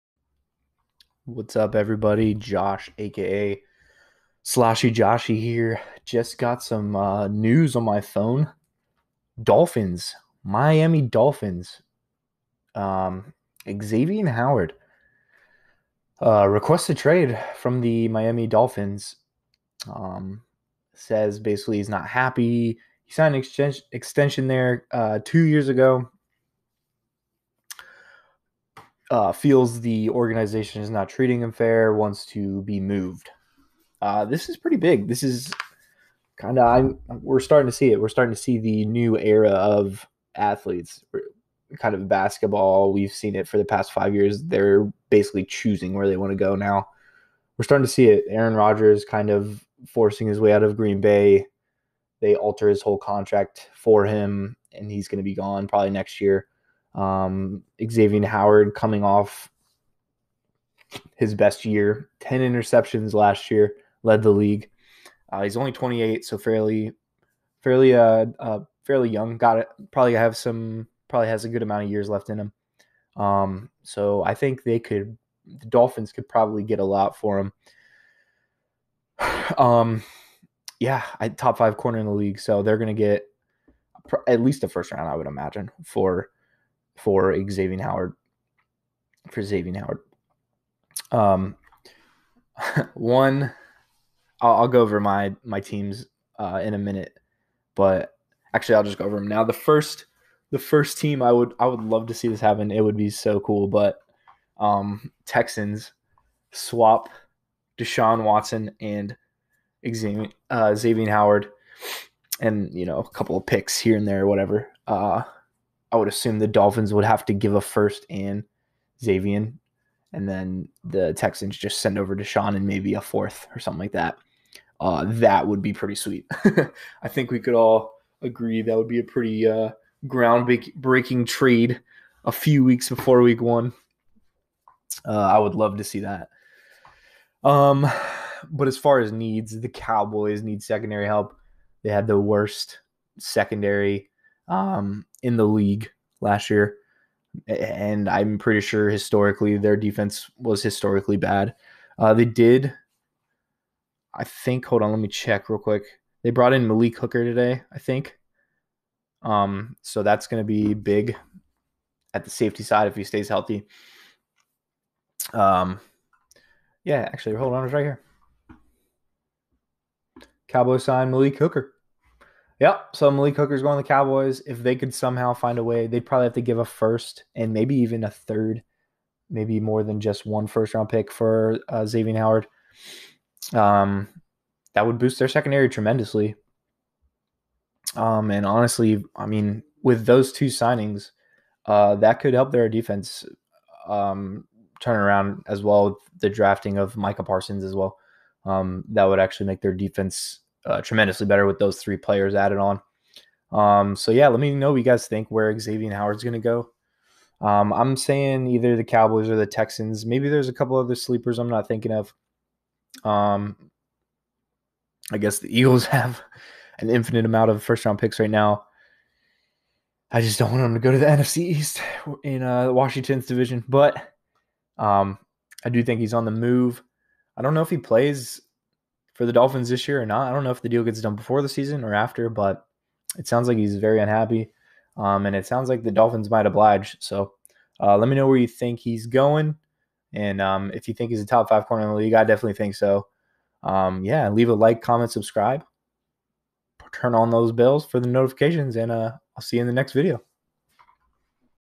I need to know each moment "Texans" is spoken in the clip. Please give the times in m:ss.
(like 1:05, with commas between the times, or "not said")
1:45, 2:01, 3:29.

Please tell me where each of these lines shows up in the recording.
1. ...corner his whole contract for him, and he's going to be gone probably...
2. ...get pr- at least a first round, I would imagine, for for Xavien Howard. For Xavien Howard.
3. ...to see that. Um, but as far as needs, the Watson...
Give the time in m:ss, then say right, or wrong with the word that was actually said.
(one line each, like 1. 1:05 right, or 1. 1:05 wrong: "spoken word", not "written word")
1. 0:52 wrong: "alter", not "corner"
2. 1:22 right
3. 2:15 wrong: "Cowboys", not "Watson".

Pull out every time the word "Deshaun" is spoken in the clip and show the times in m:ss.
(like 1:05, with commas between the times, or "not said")
1:47, 2:02.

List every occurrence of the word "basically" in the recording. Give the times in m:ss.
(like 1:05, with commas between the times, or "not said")
0:21, 0:45.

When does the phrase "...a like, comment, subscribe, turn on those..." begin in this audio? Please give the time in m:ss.
4:04.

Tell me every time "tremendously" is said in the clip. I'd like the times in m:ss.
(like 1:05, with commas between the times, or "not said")
3:05, 3:20.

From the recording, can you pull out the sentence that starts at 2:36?
They brought in Malik Hooker today, I think.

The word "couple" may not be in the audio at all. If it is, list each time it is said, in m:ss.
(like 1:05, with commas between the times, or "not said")
1:53, 3:30.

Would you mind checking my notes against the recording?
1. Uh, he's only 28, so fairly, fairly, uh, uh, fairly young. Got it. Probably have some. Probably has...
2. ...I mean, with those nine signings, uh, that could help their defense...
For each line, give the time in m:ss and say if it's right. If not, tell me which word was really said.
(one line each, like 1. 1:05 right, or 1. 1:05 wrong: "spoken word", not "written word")
1. 1:05 right
2. 3:09 wrong: "two", not "nine".